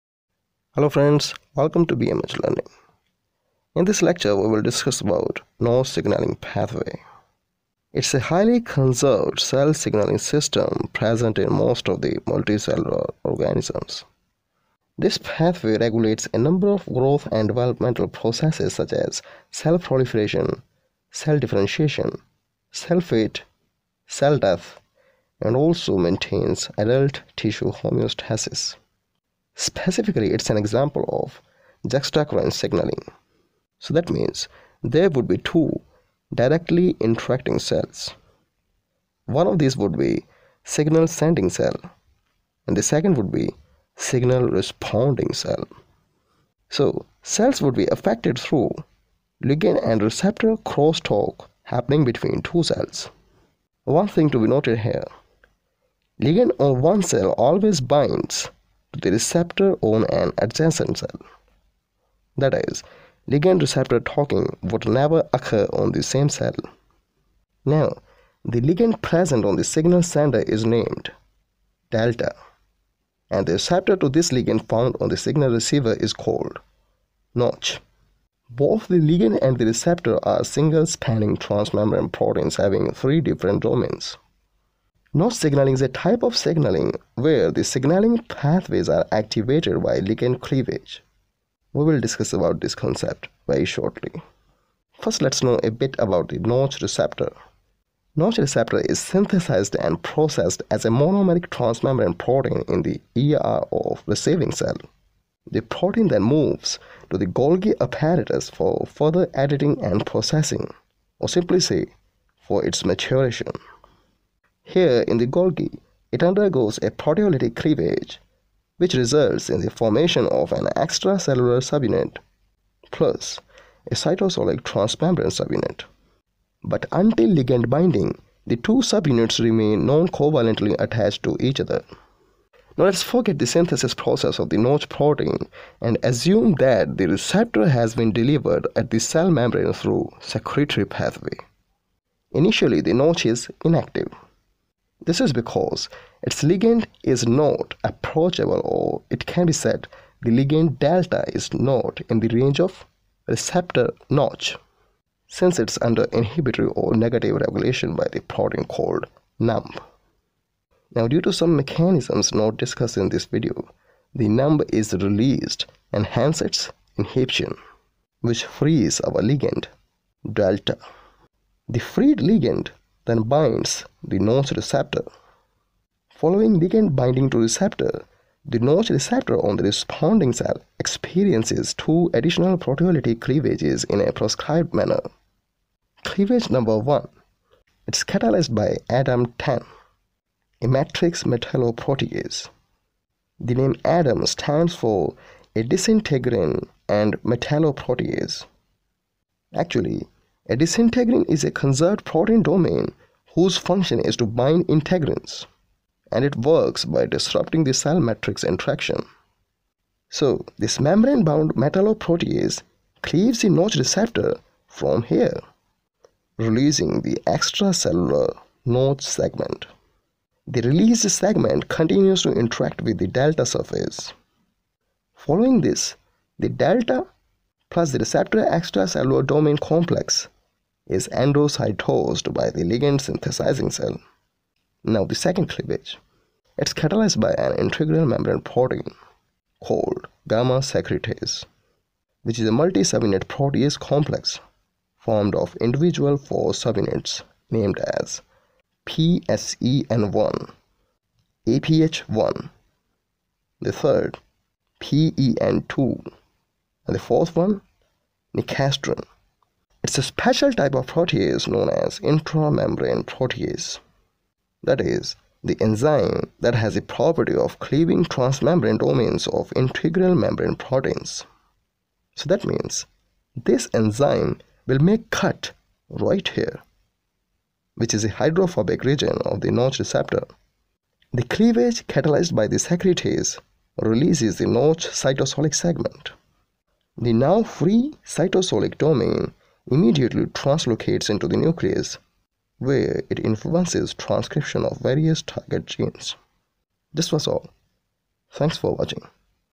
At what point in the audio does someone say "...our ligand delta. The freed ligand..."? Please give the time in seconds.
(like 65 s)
169 s.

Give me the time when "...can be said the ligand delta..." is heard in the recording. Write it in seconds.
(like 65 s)
149 s.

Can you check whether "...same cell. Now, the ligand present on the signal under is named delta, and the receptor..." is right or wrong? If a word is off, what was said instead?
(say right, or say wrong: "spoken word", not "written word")
wrong: "sender", not "under".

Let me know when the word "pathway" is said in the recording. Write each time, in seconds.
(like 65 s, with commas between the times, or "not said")
6 s, 15 s, 88 s, 140 s.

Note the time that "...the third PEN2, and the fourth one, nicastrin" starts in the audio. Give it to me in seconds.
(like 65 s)
253 s.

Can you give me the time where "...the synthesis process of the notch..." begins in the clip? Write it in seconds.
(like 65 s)
133 s.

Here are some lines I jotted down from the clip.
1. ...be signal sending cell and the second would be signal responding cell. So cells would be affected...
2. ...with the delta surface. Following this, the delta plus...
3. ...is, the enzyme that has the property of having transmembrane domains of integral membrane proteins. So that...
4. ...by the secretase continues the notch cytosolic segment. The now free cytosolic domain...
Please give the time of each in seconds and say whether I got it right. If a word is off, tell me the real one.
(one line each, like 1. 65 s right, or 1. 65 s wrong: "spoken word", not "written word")
1. 39 s right
2. 222 s right
3. 264 s wrong: "cleaving", not "having"
4. 282 s wrong: "releases", not "continues".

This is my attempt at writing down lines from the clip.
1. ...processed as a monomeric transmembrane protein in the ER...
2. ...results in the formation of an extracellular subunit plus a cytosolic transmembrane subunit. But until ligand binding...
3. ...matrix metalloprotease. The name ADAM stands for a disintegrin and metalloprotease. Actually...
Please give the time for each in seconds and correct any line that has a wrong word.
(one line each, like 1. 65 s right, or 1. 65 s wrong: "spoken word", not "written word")
1. 100 s right
2. 118 s right
3. 190 s right.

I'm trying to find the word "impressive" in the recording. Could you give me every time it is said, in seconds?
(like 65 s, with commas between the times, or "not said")
not said.